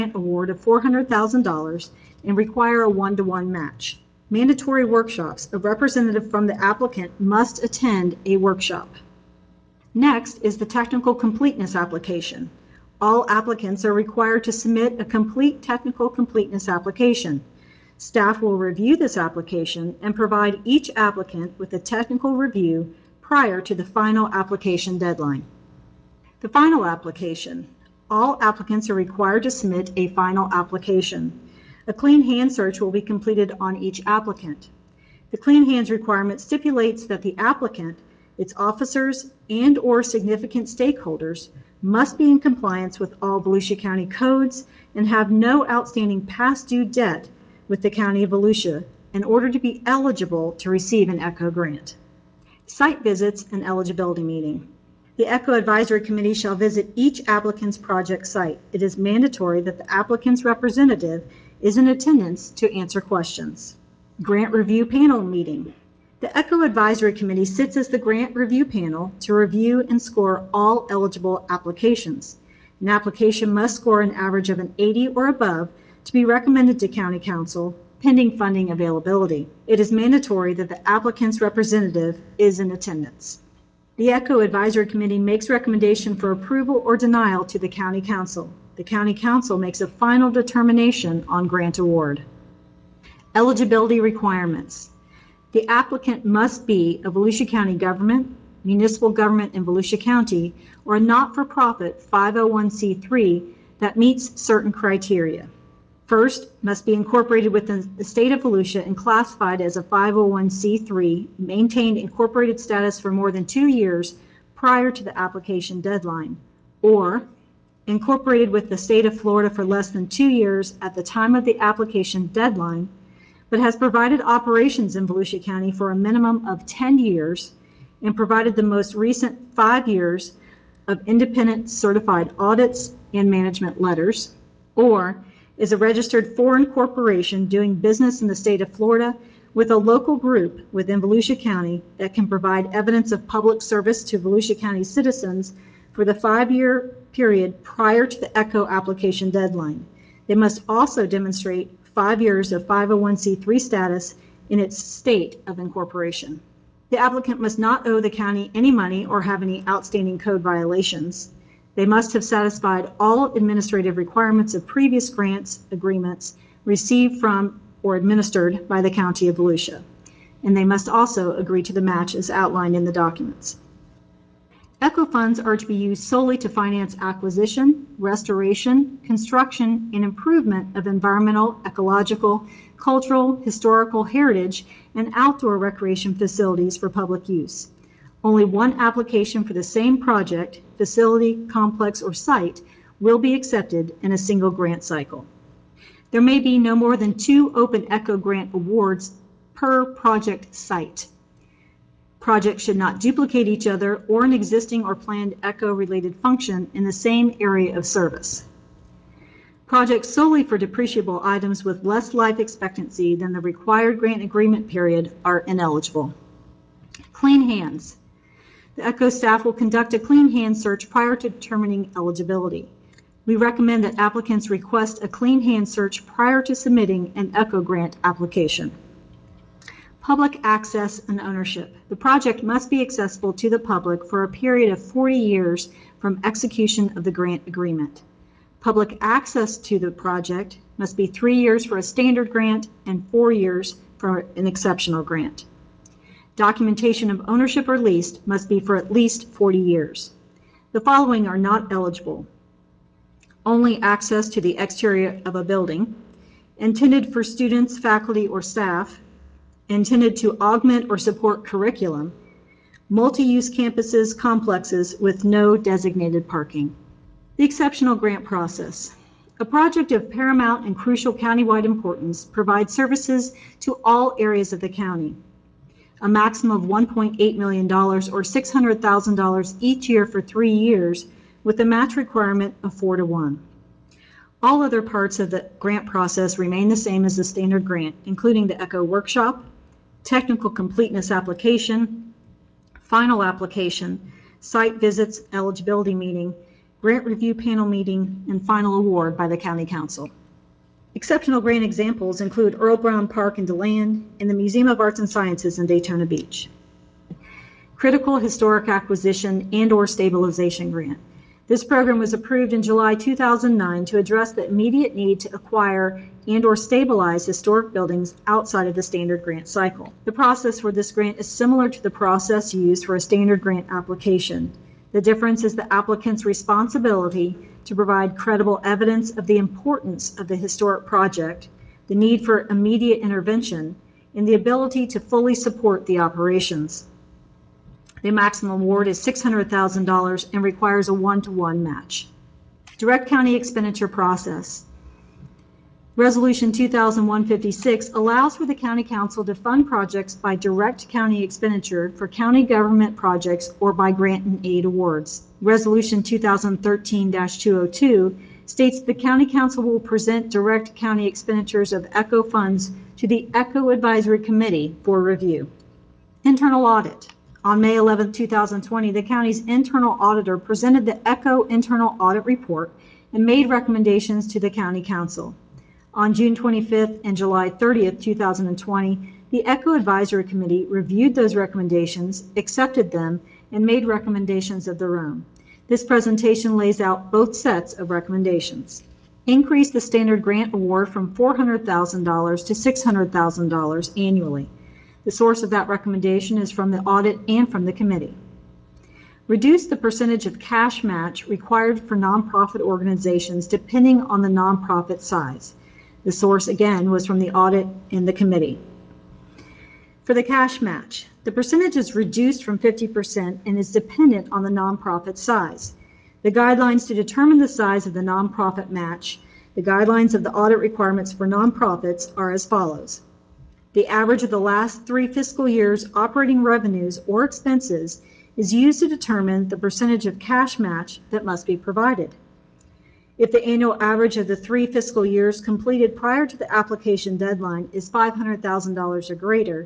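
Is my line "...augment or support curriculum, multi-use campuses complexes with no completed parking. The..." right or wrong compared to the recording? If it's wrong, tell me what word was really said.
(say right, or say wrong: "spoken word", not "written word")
wrong: "designated", not "completed".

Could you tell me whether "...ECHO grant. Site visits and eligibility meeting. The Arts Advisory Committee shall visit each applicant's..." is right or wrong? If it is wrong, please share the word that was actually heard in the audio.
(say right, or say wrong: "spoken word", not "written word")
wrong: "ECHO", not "Arts".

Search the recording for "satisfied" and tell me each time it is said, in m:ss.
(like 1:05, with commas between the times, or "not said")
2:42.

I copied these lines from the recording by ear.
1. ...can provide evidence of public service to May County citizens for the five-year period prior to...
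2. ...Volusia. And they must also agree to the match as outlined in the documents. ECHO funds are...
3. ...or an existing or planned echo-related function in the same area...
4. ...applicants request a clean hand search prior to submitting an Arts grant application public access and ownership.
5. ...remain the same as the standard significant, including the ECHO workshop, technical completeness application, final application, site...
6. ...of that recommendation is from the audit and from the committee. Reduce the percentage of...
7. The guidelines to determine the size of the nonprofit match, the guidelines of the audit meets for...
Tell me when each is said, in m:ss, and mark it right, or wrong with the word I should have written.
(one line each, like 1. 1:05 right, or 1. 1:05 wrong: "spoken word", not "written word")
1. 2:22 wrong: "Volusia", not "May"
2. 2:49 right
3. 3:24 right
4. 3:43 wrong: "ECHO", not "Arts"
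5. 4:46 wrong: "grant", not "significant"
6. 6:35 right
7. 6:56 wrong: "requirements", not "meets".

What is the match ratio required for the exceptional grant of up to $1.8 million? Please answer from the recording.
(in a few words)
4 to 1.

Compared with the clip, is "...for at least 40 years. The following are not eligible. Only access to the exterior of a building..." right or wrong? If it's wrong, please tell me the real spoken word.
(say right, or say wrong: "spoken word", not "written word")
right.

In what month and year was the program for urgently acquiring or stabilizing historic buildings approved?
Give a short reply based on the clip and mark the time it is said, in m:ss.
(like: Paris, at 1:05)
July 2009, at 5:12.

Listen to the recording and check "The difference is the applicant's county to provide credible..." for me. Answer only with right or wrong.
wrong.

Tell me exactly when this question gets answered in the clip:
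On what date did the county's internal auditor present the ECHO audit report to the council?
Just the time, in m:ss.
6:07.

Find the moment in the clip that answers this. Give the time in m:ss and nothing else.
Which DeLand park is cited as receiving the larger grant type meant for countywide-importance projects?
5:02.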